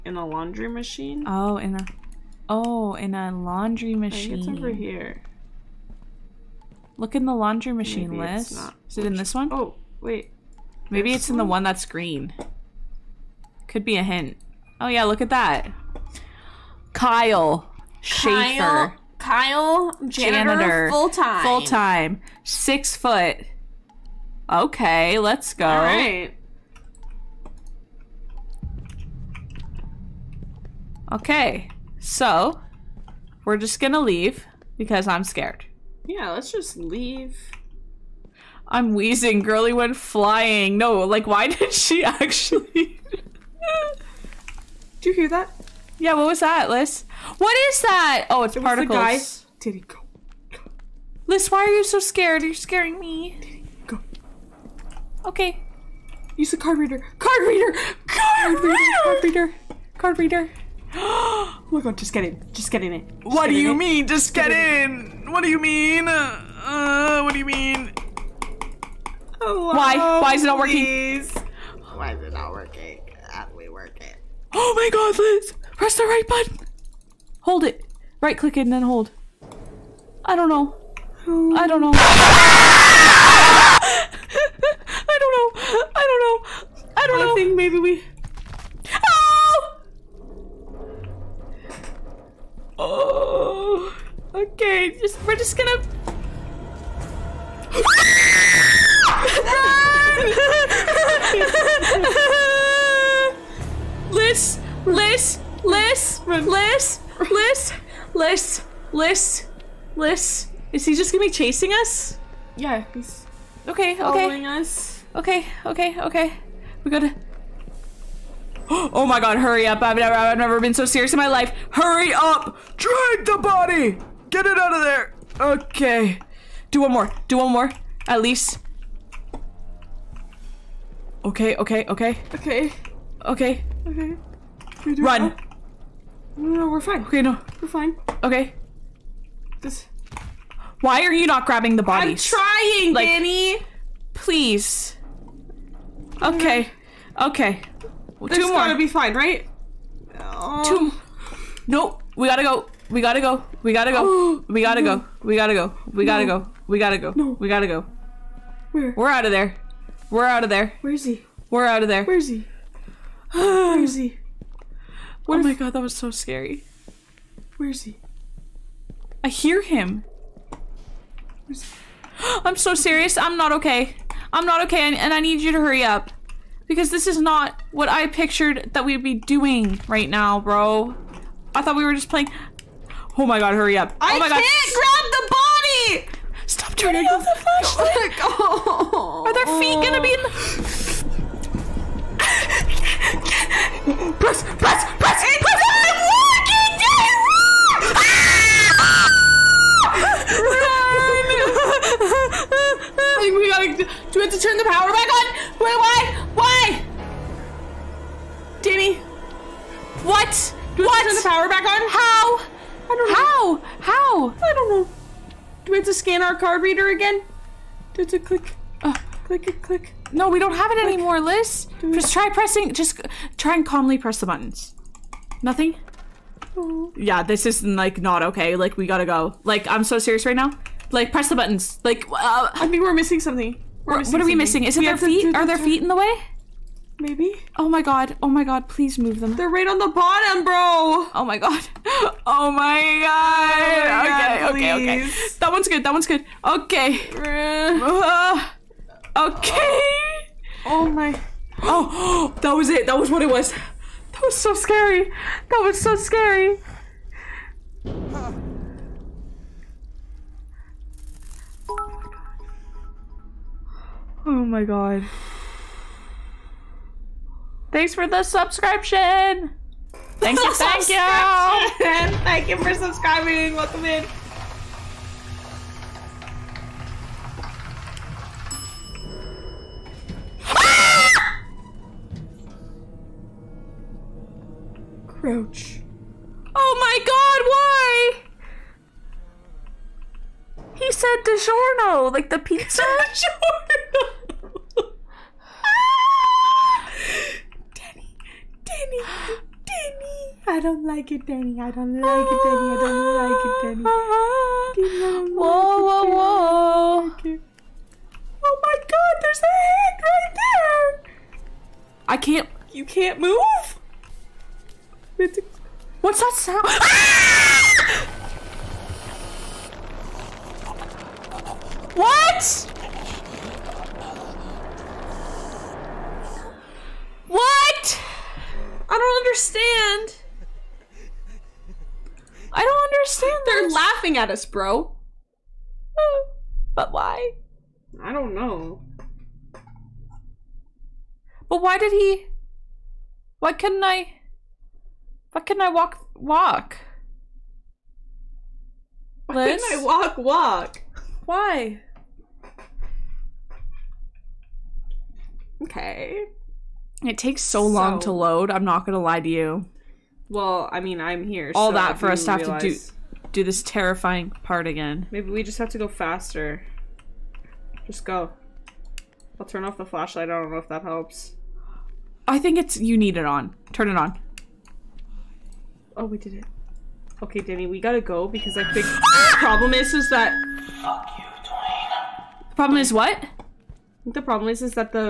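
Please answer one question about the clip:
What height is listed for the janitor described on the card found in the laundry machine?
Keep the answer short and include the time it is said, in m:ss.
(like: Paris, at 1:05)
Six foot, at 0:22.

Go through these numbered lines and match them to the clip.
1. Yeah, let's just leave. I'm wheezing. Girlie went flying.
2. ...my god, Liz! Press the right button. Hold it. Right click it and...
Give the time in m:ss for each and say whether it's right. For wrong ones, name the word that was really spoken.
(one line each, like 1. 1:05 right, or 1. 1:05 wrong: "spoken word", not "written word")
1. 0:36 right
2. 1:14 right.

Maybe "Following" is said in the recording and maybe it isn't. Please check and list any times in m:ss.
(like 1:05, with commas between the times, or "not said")
1:53.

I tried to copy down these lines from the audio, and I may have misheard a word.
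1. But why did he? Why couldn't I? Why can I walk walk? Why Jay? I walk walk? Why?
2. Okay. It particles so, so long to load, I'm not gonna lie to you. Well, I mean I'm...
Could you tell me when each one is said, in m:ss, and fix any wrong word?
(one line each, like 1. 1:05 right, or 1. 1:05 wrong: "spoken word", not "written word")
1. 5:41 wrong: "Liz", not "Jay"
2. 5:55 wrong: "takes", not "particles".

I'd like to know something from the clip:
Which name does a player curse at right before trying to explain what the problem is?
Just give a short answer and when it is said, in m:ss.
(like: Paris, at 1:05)
Dwayne, at 6:20.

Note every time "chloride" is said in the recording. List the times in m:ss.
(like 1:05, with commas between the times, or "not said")
not said.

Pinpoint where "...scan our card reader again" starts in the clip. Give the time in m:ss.
3:35.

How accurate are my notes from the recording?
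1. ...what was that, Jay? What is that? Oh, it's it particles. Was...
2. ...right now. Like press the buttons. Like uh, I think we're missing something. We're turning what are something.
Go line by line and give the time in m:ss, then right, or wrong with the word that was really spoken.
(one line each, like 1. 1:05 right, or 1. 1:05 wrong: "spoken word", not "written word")
1. 0:46 wrong: "Liz", not "Jay"
2. 3:50 wrong: "missing", not "turning".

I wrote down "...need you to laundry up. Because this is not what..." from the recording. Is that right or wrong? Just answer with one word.
wrong.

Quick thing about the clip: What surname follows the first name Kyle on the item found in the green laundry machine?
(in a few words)
Schaefer.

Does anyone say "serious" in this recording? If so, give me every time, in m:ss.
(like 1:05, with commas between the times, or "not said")
2:00, 2:52, 3:49.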